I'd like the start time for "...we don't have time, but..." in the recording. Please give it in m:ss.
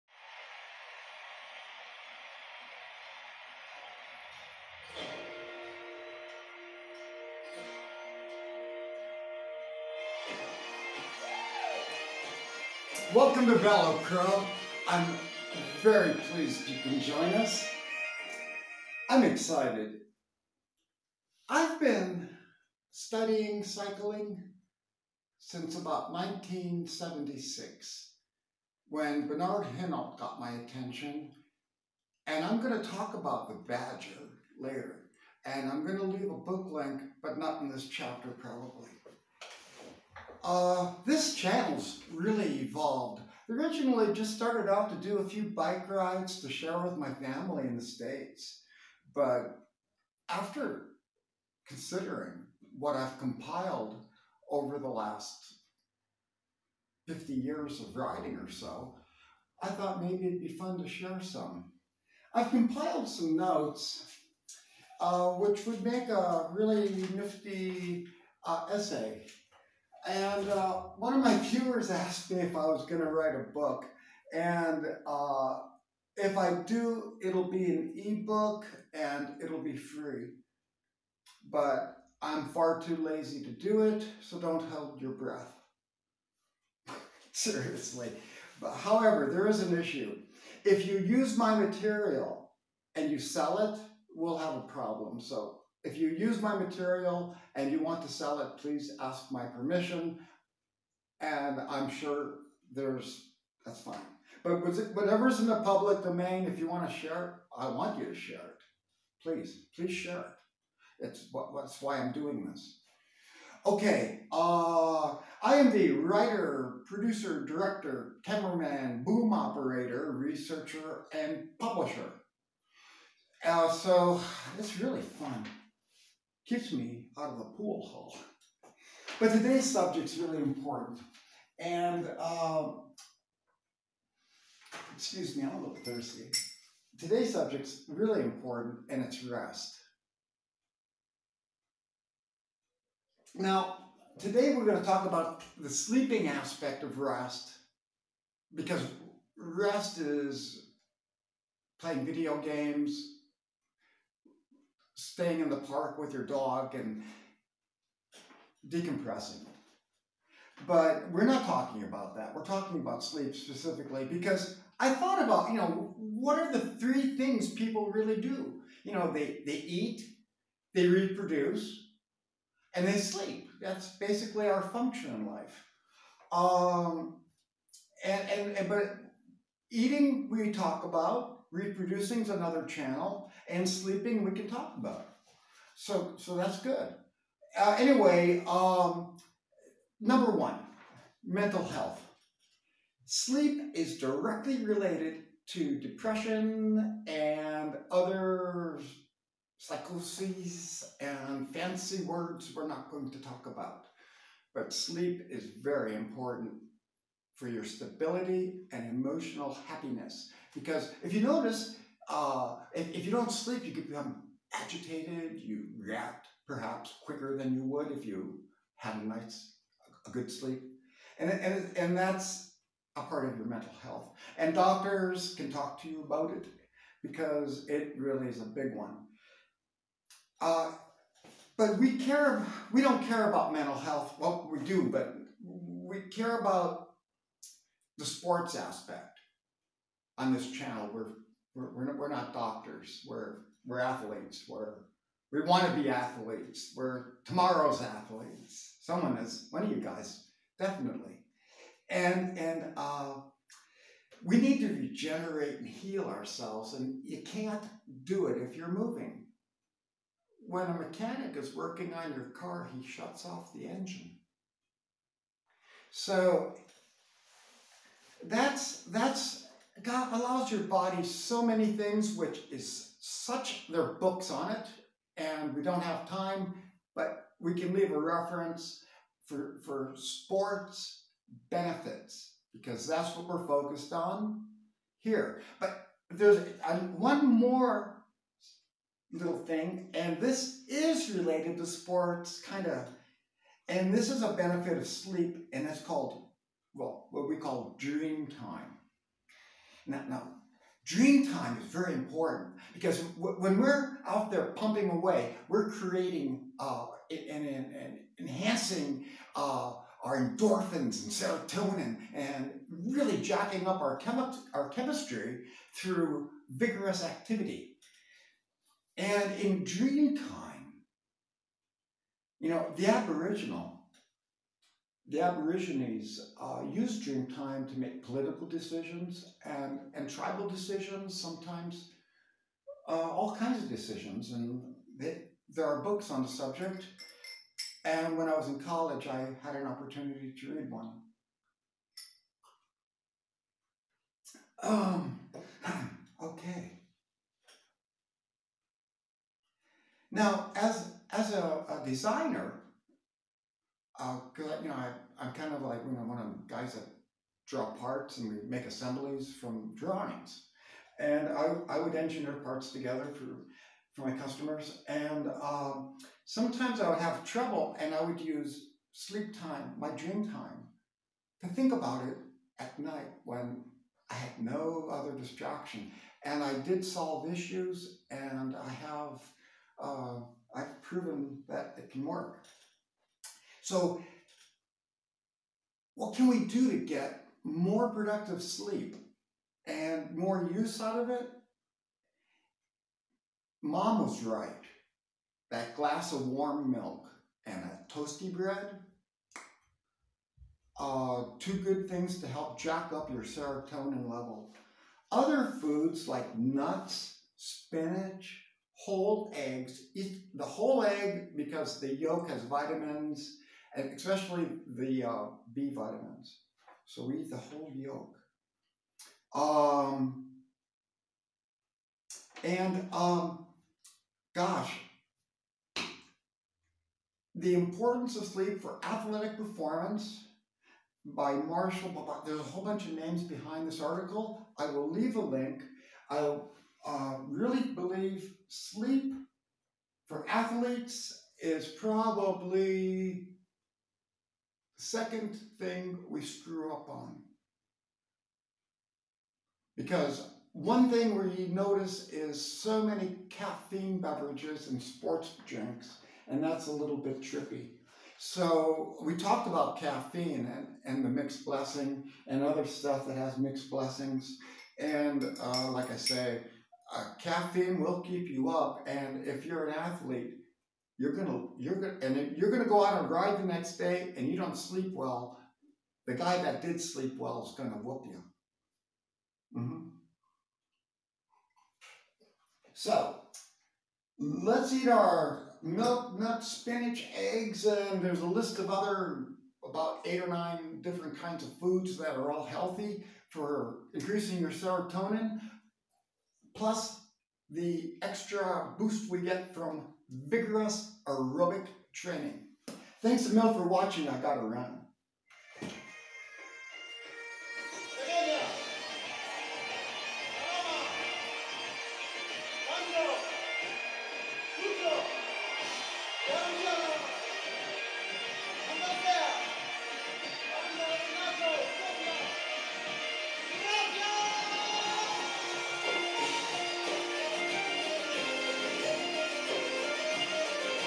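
4:35.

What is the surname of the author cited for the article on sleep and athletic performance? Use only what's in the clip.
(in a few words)
Marshall.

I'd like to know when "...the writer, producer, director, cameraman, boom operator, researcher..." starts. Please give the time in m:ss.
1:55.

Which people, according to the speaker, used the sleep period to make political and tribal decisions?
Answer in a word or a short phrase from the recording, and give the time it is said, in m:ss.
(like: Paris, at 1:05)
the Aborigines, at 5:25.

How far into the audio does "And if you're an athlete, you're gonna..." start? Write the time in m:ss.
7:48.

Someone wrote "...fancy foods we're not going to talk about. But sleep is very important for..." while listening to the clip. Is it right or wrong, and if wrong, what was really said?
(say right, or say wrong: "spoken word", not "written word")
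wrong: "words", not "foods".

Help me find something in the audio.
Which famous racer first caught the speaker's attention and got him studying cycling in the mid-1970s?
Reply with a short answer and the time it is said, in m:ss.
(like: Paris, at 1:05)
Bernard Hinault, at 0:29.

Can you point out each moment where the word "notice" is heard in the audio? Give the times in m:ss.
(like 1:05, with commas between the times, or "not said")
3:31, 7:31.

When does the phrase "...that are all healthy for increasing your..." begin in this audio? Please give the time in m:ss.
8:11.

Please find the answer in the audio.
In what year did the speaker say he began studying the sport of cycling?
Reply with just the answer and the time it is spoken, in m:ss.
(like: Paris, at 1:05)
1976, at 0:26.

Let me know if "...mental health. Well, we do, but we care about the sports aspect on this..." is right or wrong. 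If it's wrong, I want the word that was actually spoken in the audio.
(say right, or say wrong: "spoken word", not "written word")
right.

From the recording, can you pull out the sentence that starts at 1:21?
But I'm far too lazy to do it, so don't hold your breath.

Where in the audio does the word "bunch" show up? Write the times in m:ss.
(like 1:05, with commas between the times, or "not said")
7:12.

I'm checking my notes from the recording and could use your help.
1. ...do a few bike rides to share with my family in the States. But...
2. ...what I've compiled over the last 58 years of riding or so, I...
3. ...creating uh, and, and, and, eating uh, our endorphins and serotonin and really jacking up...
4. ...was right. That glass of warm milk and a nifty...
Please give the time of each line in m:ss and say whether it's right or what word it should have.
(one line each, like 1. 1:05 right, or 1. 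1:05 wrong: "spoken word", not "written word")
1. 0:45 right
2. 0:52 wrong: "50", not "58"
3. 5:05 wrong: "enhancing", not "eating"
4. 6:34 wrong: "toasty", not "nifty".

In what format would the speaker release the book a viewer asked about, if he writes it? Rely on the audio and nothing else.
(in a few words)
ebook.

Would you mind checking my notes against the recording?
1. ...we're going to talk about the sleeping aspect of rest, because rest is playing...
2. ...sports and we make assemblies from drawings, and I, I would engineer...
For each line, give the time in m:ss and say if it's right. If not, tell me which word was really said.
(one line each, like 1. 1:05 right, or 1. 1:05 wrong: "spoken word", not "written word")
1. 2:24 right
2. 5:57 wrong: "parts", not "sports".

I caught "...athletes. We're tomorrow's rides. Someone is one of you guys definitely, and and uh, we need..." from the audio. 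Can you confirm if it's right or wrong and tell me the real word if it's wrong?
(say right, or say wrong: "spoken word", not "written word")
wrong: "athletes", not "rides".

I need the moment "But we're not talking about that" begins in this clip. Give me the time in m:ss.
2:40.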